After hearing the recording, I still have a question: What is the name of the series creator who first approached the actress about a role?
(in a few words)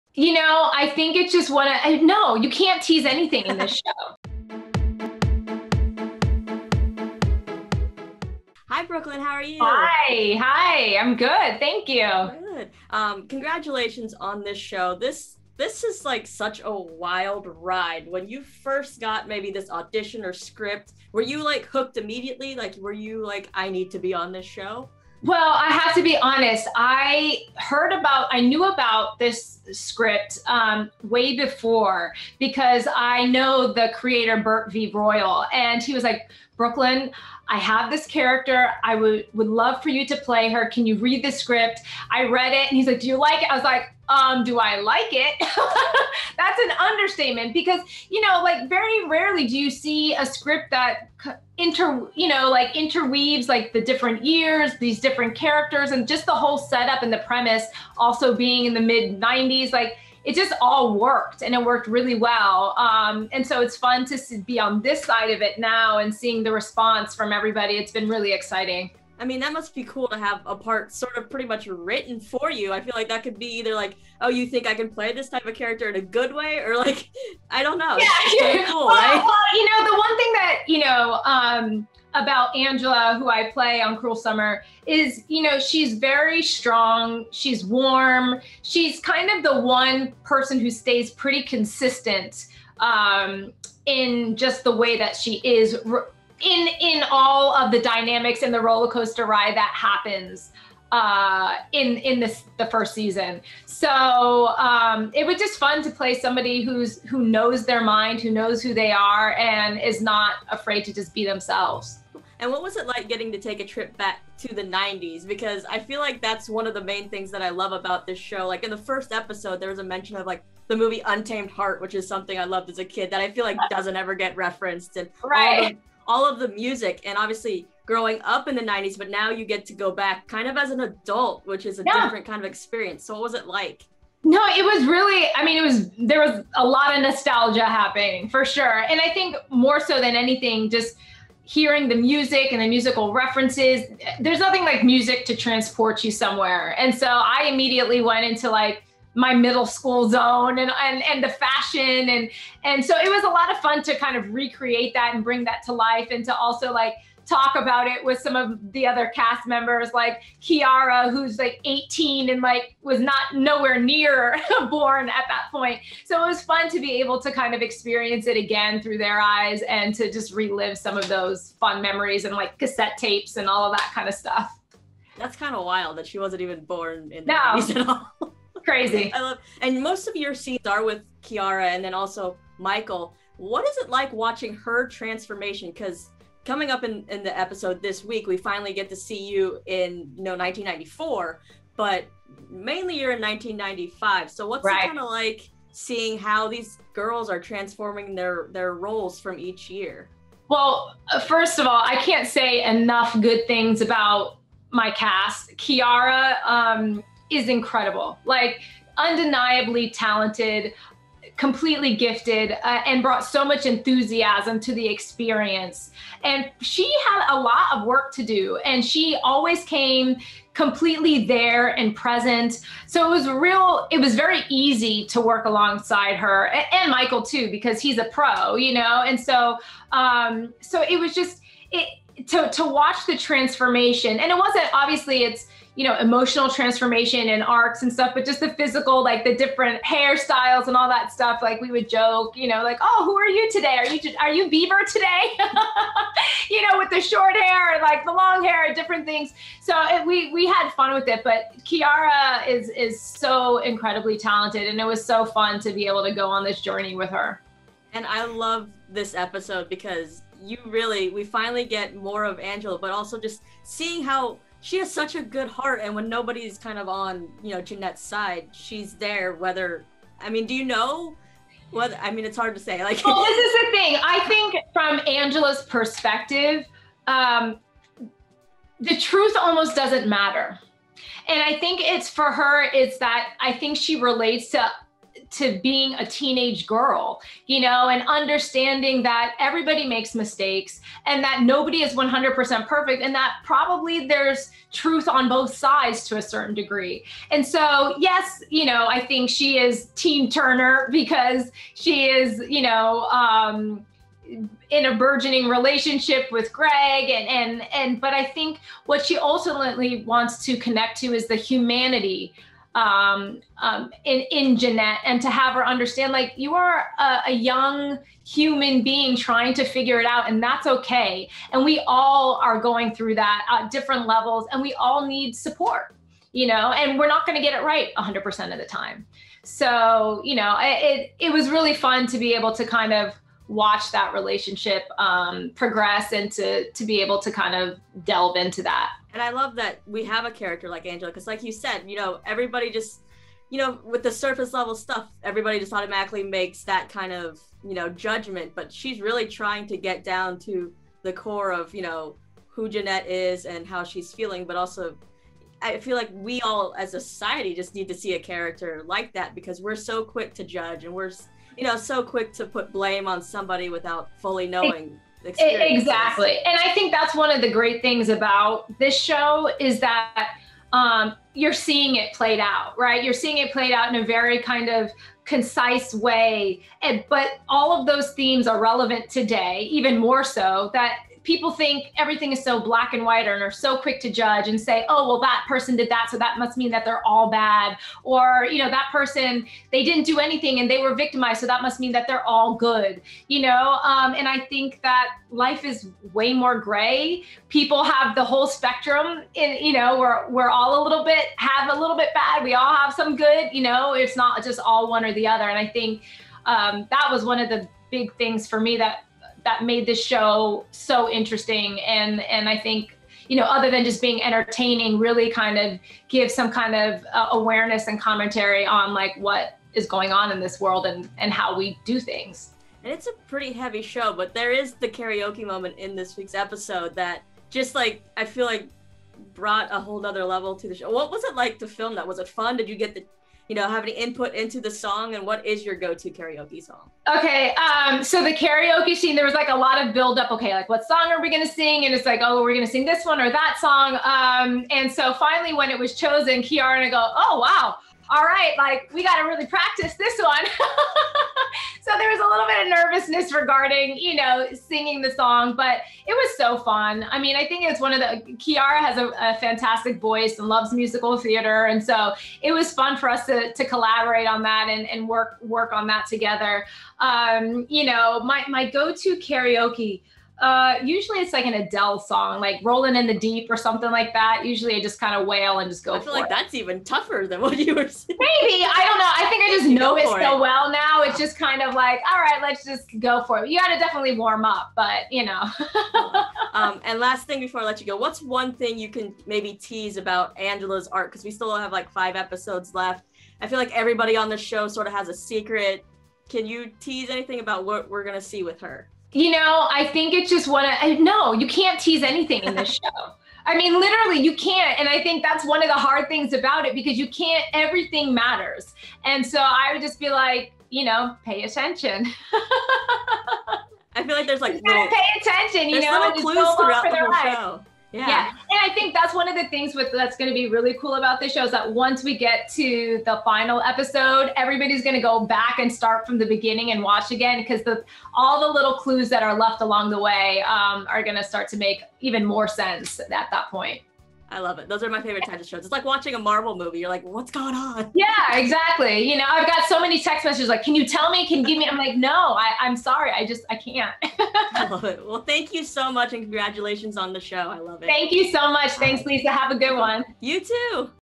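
Burt V. Royal.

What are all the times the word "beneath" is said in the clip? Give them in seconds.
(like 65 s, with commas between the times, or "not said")
not said.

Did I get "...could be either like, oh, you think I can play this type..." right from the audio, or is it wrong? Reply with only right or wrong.
right.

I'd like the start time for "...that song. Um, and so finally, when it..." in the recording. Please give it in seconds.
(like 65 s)
443 s.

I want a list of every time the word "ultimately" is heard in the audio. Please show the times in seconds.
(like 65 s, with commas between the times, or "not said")
309 s.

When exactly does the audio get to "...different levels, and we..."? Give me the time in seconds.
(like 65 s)
323 s.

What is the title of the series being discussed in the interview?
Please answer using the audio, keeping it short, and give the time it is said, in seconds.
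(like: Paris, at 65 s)
Cruel Summer, at 83 s.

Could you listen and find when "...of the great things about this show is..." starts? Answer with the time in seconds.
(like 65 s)
367 s.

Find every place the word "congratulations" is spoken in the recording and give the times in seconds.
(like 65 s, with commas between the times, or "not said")
13 s, 546 s.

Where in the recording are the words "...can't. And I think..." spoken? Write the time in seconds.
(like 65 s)
504 s.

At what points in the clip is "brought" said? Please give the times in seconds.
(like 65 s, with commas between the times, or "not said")
213 s, 429 s.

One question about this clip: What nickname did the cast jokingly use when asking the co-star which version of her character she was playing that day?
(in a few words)
Beaver.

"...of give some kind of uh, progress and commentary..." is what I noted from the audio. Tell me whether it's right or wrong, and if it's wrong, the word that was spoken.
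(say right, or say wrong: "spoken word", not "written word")
wrong: "awareness", not "progress".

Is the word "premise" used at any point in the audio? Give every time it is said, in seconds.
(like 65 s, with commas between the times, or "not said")
57 s.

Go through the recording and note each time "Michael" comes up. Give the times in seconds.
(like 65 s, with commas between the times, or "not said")
182 s, 226 s.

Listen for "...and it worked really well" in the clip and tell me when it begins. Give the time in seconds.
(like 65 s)
61 s.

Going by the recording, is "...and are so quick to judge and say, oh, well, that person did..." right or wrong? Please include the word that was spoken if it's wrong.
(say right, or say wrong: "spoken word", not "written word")
right.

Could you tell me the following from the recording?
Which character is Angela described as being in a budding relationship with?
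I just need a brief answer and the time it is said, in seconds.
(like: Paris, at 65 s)
Greg, at 306 s.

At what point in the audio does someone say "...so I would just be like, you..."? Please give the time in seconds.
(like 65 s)
509 s.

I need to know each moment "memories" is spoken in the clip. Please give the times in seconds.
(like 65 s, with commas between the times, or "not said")
171 s.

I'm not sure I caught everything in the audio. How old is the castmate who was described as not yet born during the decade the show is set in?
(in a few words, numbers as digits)
18.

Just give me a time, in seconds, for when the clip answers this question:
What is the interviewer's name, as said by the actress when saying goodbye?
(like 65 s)
549 s.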